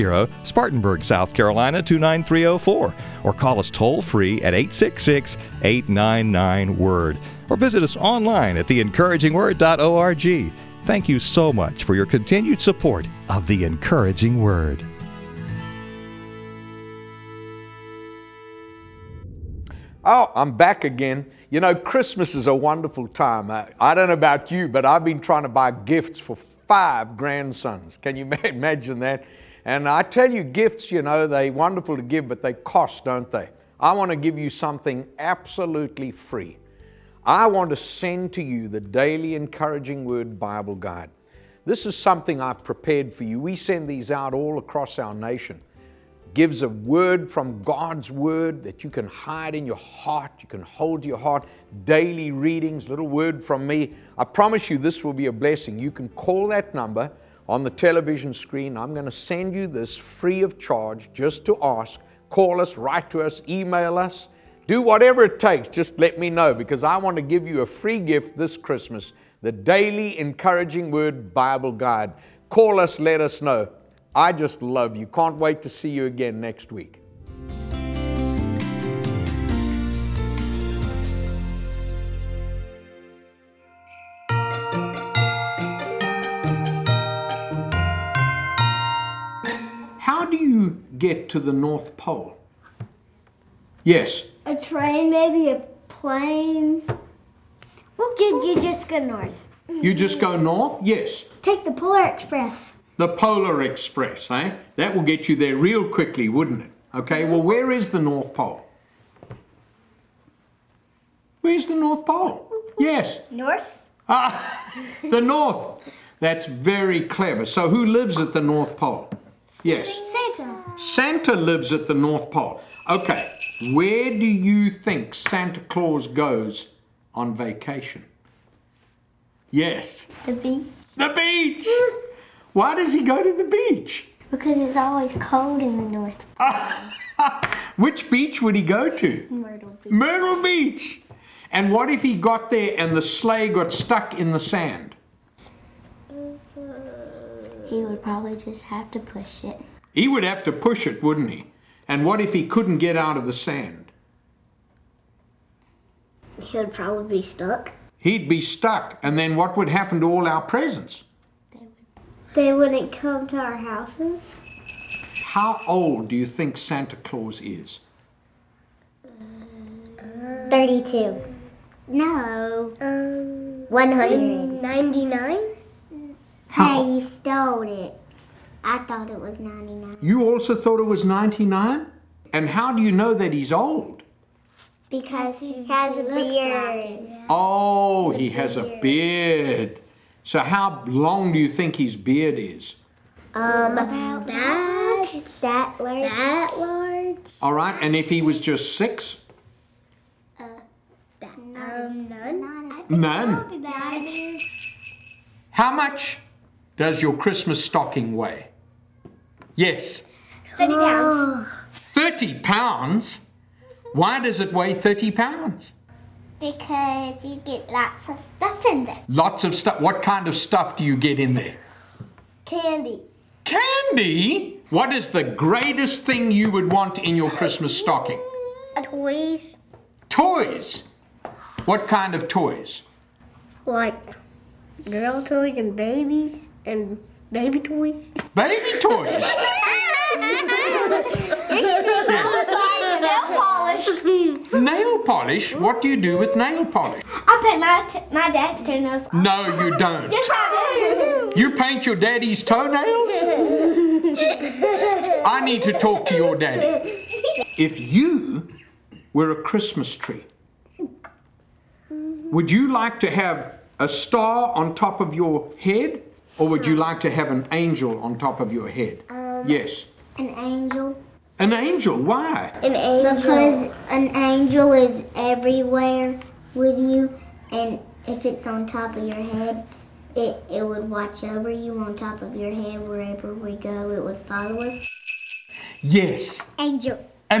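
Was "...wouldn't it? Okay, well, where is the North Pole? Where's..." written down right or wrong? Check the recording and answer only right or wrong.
right.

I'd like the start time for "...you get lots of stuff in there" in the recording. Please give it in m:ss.
3:37.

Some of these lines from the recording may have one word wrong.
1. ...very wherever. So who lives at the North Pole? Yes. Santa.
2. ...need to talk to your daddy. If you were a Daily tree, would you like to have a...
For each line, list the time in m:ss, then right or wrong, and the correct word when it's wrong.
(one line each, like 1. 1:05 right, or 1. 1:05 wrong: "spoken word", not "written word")
1. 1:56 wrong: "clever", not "wherever"
2. 4:15 wrong: "Christmas", not "Daily".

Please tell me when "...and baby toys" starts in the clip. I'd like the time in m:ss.
3:56.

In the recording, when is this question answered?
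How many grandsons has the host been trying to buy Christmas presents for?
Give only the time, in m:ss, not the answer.
0:26.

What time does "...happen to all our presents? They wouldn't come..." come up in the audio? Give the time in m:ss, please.
2:39.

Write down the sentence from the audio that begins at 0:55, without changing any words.
You can call that number on the television screen.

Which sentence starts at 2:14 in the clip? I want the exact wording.
Because it's always cold in the North Pole.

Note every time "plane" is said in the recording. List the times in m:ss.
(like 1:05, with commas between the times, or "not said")
1:35.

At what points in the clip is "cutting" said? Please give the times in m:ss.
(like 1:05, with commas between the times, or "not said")
not said.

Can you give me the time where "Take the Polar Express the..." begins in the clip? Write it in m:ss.
1:41.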